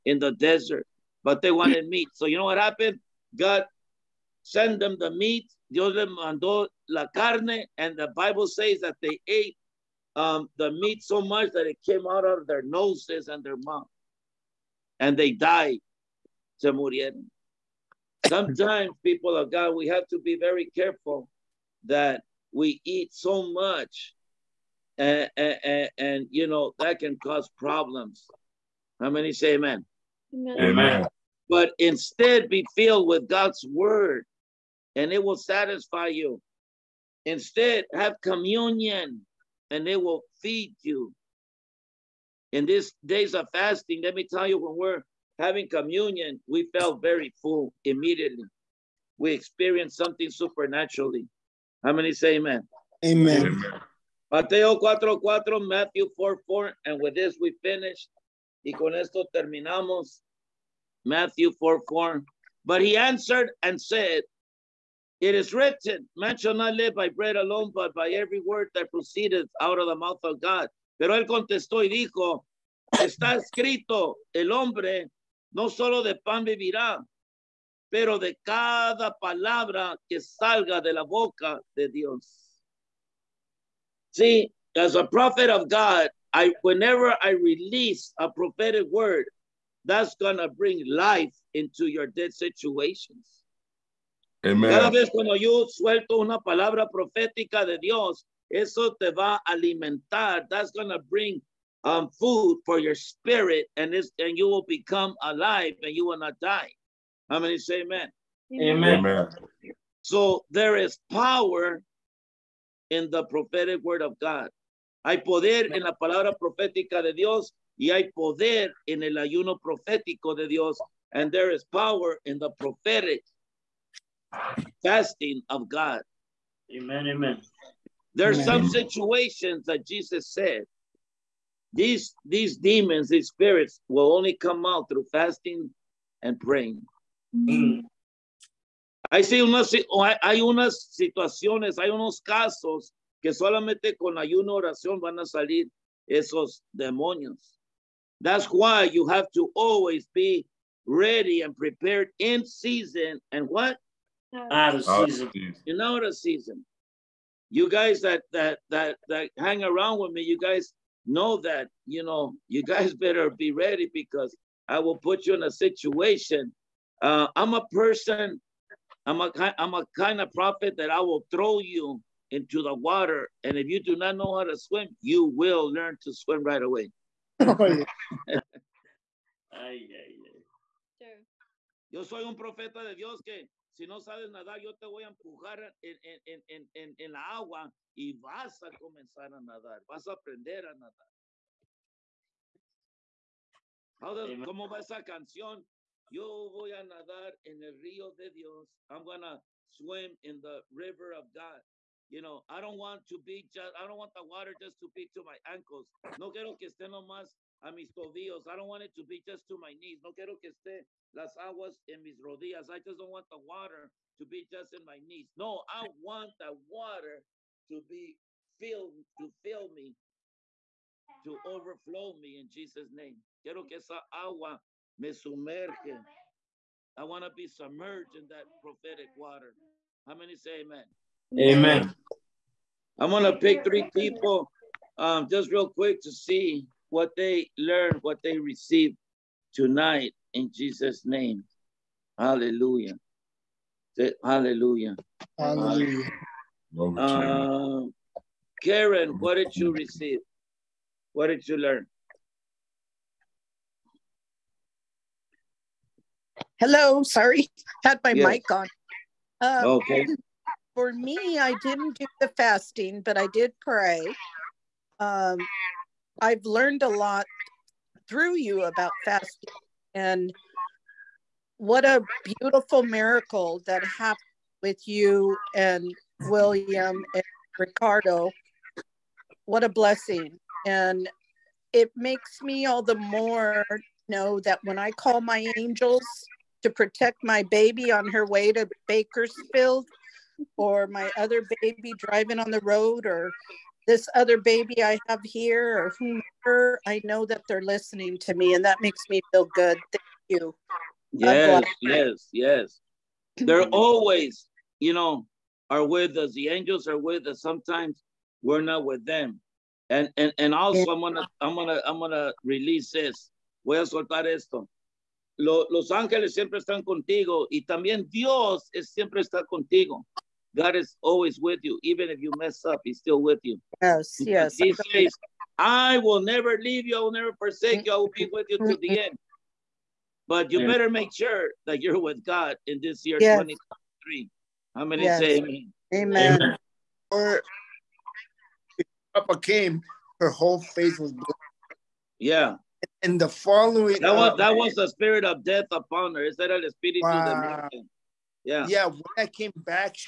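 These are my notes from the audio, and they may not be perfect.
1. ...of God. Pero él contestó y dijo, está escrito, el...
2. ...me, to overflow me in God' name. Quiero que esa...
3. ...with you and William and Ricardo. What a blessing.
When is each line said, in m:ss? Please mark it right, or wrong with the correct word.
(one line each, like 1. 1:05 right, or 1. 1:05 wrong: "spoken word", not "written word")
1. 1:10 right
2. 3:39 wrong: "Jesus", not "God"
3. 4:34 right.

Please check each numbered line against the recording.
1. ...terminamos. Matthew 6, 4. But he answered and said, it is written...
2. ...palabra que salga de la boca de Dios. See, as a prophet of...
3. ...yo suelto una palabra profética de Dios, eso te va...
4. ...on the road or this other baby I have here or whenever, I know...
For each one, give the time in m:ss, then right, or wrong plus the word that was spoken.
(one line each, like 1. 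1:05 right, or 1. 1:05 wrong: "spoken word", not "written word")
1. 0:59 wrong: "4", not "6"
2. 1:19 right
3. 1:35 right
4. 4:52 wrong: "whomever", not "whenever".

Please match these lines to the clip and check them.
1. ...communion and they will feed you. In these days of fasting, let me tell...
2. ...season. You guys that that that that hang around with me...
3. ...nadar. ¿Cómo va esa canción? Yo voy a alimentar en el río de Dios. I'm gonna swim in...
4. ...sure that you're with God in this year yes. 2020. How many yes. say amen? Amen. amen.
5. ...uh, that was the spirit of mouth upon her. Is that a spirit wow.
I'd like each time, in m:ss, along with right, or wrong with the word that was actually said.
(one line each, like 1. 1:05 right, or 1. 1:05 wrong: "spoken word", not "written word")
1. 0:38 right
2. 2:36 right
3. 3:10 wrong: "nadar", not "alimentar"
4. 5:31 wrong: "2023", not "2020"
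5. 5:44 wrong: "death", not "mouth".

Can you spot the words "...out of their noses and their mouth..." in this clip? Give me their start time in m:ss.
0:12.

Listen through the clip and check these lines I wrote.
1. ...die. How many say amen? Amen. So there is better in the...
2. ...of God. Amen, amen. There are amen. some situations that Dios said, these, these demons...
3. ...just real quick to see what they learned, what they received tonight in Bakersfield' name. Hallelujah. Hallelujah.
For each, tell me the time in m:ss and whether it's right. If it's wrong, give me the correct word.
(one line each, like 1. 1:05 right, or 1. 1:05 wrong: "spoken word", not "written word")
1. 1:46 wrong: "power", not "better"
2. 2:05 wrong: "Jesus", not "Dios"
3. 3:55 wrong: "Jesus", not "Bakersfield".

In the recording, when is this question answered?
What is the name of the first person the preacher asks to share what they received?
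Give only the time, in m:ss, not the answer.
4:08.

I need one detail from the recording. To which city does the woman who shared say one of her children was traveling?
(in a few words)
Bakersfield.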